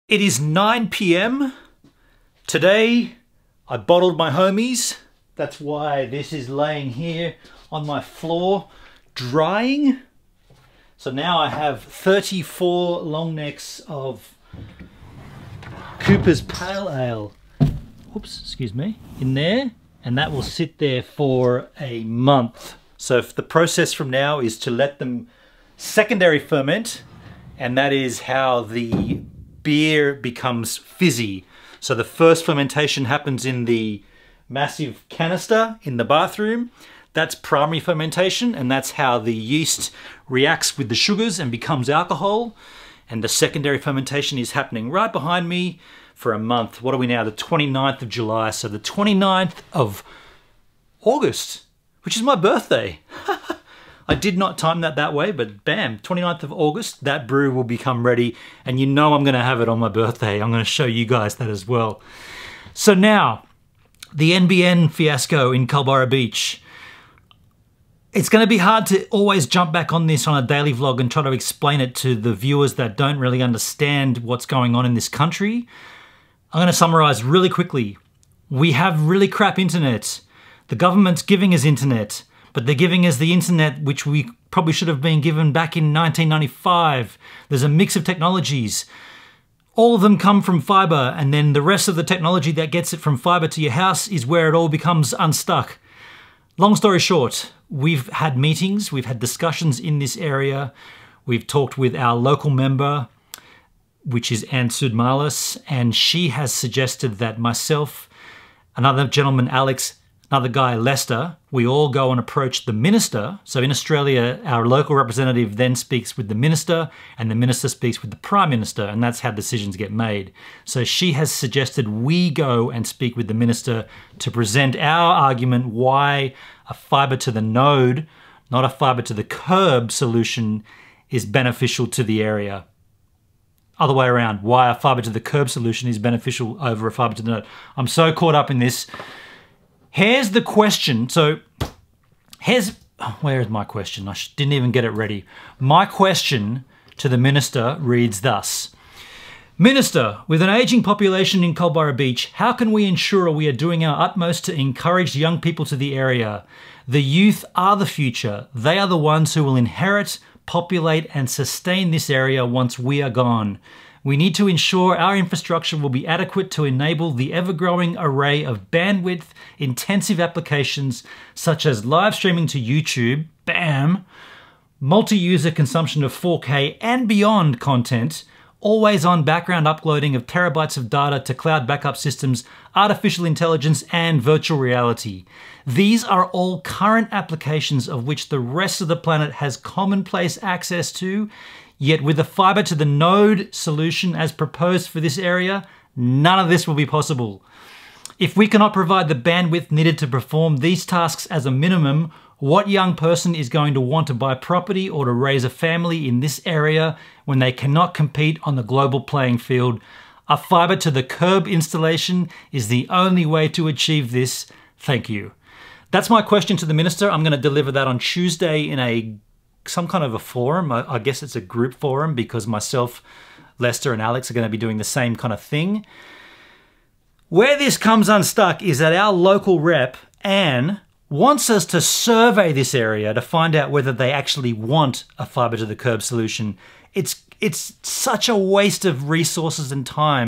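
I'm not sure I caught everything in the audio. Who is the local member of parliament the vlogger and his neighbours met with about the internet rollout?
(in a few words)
Ann Sudmalis.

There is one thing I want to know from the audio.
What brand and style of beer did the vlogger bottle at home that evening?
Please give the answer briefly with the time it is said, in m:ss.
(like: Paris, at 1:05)
Cooper's Pale Ale, at 0:15.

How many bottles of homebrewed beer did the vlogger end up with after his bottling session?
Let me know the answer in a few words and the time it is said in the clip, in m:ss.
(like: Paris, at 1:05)
34, at 0:11.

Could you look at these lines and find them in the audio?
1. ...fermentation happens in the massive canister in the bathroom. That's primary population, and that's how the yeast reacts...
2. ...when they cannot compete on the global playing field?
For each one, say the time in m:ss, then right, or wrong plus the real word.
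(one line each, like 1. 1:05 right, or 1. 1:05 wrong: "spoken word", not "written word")
1. 0:32 wrong: "fermentation", not "population"
2. 3:27 right.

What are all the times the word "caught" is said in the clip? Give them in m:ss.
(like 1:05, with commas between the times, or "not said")
2:18.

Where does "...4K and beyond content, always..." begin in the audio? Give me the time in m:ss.
2:56.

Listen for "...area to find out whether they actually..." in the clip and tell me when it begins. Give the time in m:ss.
3:52.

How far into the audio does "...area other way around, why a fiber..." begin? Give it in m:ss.
2:12.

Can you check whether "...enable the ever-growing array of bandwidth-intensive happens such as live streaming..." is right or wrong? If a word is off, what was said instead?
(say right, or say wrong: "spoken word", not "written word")
wrong: "applications", not "happens".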